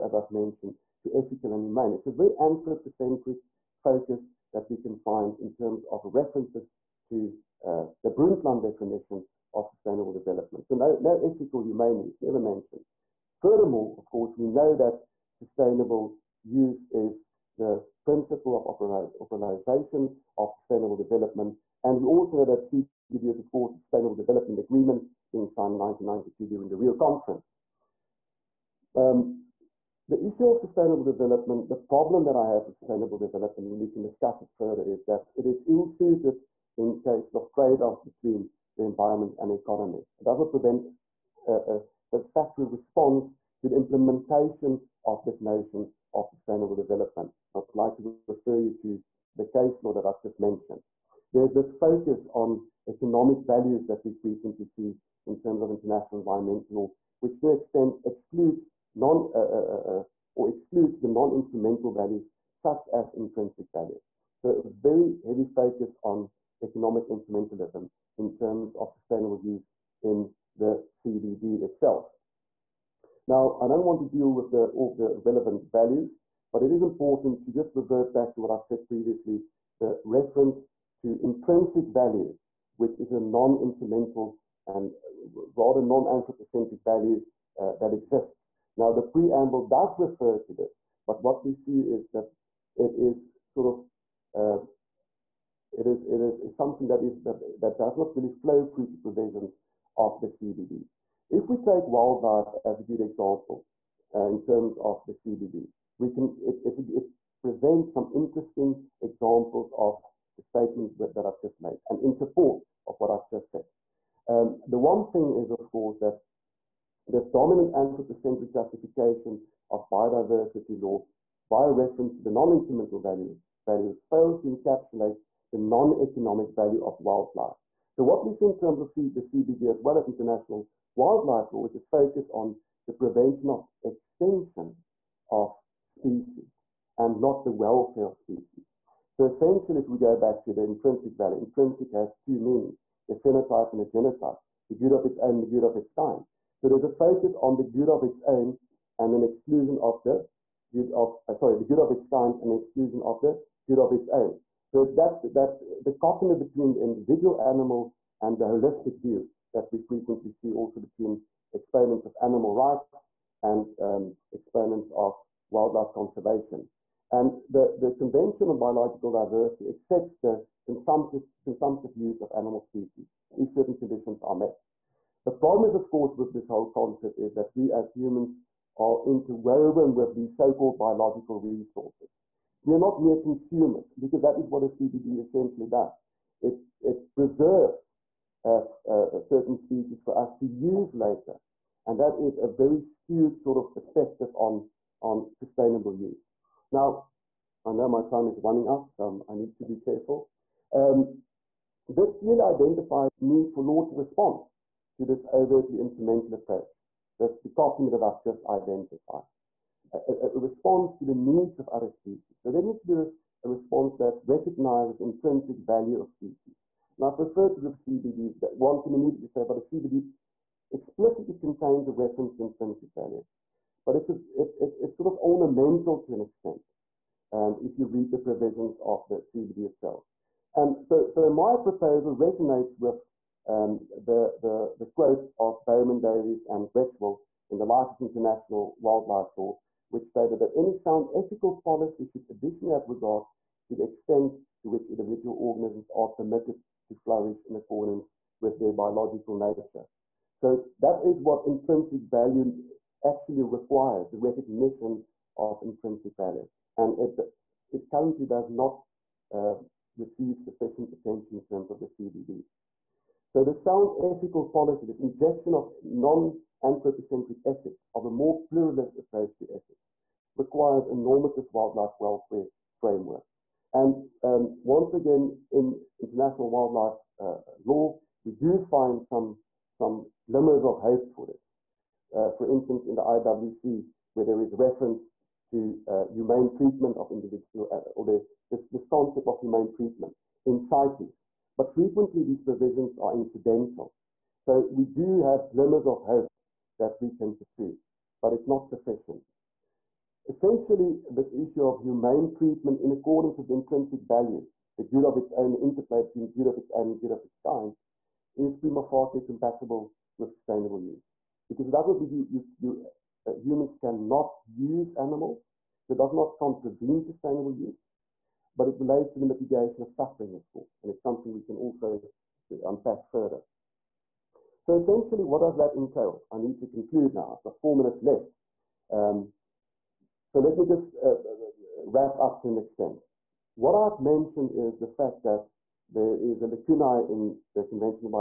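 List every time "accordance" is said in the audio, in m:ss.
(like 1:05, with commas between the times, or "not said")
4:07, 5:02.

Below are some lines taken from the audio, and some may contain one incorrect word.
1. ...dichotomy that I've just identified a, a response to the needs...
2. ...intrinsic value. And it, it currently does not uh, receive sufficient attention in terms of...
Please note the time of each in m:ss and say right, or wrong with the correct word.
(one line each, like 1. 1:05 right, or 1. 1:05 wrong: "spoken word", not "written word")
1. 3:27 right
2. 4:15 right.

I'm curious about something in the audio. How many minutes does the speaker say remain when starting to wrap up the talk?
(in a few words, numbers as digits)
4.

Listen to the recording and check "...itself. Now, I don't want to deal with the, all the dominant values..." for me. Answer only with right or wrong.
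wrong.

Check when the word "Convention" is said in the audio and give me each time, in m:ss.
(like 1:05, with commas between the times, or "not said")
2:47, 5:37.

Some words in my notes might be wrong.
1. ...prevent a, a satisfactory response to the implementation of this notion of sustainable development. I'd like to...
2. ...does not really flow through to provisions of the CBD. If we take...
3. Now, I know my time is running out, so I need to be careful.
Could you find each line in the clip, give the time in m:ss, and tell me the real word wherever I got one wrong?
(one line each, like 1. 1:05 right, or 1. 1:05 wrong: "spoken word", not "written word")
1. 0:40 right
2. 1:37 right
3. 3:16 right.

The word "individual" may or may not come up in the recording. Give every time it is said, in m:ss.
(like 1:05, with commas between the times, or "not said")
2:36, 4:04, 4:47.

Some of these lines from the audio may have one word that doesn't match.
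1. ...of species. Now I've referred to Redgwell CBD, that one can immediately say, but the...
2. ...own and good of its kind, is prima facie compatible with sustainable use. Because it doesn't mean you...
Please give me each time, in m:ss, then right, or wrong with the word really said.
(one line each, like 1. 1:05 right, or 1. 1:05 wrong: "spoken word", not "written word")
1. 3:36 wrong: "RIP", not "Redgwell"
2. 5:06 right.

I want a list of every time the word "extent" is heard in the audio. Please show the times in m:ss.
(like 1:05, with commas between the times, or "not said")
0:57, 3:46, 4:03, 5:32.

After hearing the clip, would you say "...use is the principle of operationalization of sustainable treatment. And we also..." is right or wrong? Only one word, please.
wrong.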